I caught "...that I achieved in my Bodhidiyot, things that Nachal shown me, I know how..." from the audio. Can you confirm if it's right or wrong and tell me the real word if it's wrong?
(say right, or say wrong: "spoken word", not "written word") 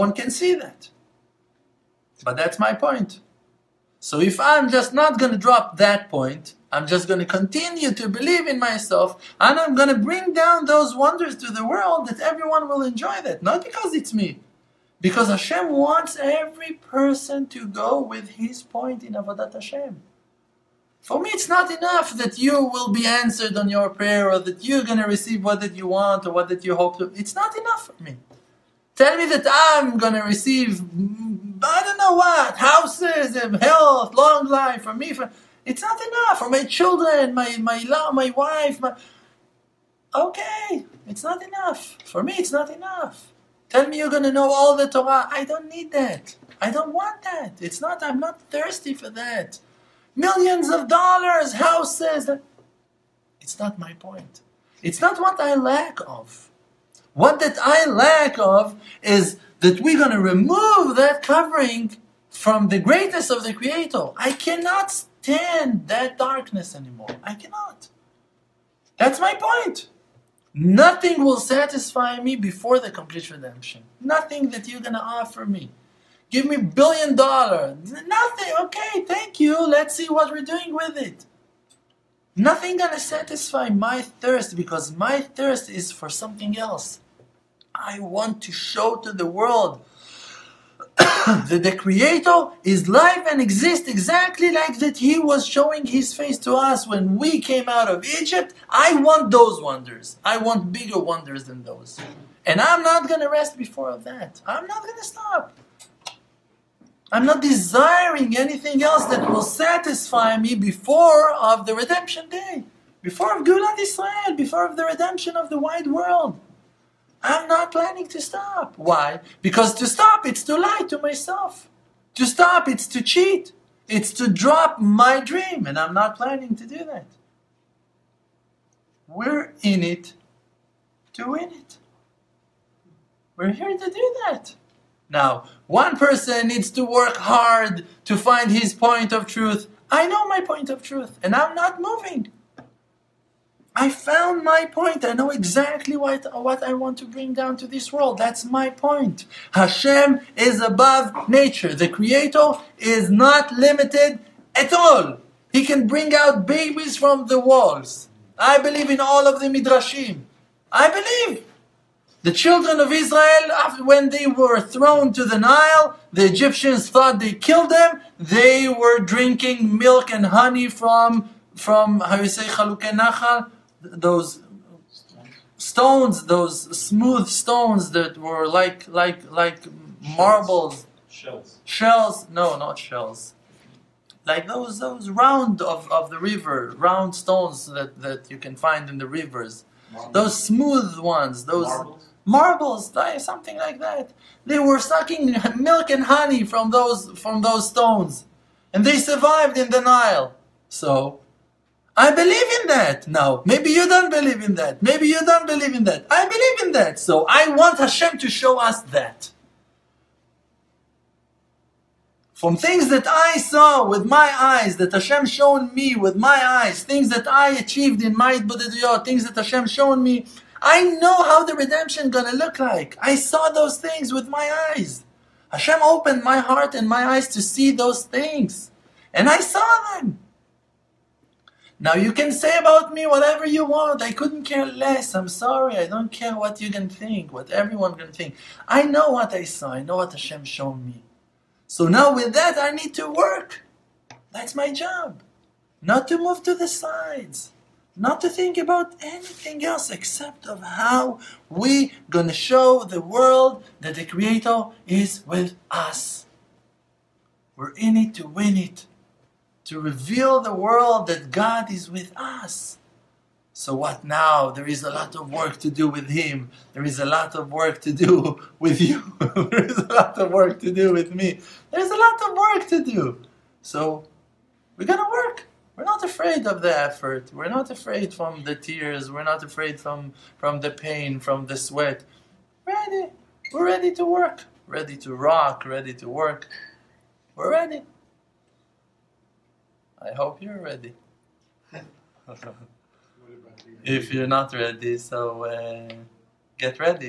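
wrong: "Hashem", not "Nachal".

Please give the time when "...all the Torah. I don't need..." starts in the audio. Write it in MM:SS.
00:44.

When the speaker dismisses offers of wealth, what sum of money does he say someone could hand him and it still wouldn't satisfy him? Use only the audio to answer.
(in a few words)
billion dollar.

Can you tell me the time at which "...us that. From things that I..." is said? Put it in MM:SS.
03:28.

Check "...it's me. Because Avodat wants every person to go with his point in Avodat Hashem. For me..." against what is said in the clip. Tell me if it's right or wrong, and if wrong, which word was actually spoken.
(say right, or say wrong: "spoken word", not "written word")
wrong: "Hashem", not "Avodat".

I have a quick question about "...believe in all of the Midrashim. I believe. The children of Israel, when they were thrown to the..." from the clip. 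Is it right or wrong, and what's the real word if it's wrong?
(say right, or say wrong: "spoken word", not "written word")
right.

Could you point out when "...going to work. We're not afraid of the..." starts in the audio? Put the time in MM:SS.
04:34.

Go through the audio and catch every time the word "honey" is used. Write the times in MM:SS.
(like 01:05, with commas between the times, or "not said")
02:50, 03:16.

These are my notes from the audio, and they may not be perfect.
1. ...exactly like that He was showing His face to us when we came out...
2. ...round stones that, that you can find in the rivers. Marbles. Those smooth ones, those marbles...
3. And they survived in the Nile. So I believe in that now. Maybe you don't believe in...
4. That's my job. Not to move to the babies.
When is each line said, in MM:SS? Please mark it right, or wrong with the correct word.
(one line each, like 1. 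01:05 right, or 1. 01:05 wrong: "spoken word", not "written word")
1. 01:33 right
2. 03:06 right
3. 03:18 right
4. 04:04 wrong: "sides", not "babies".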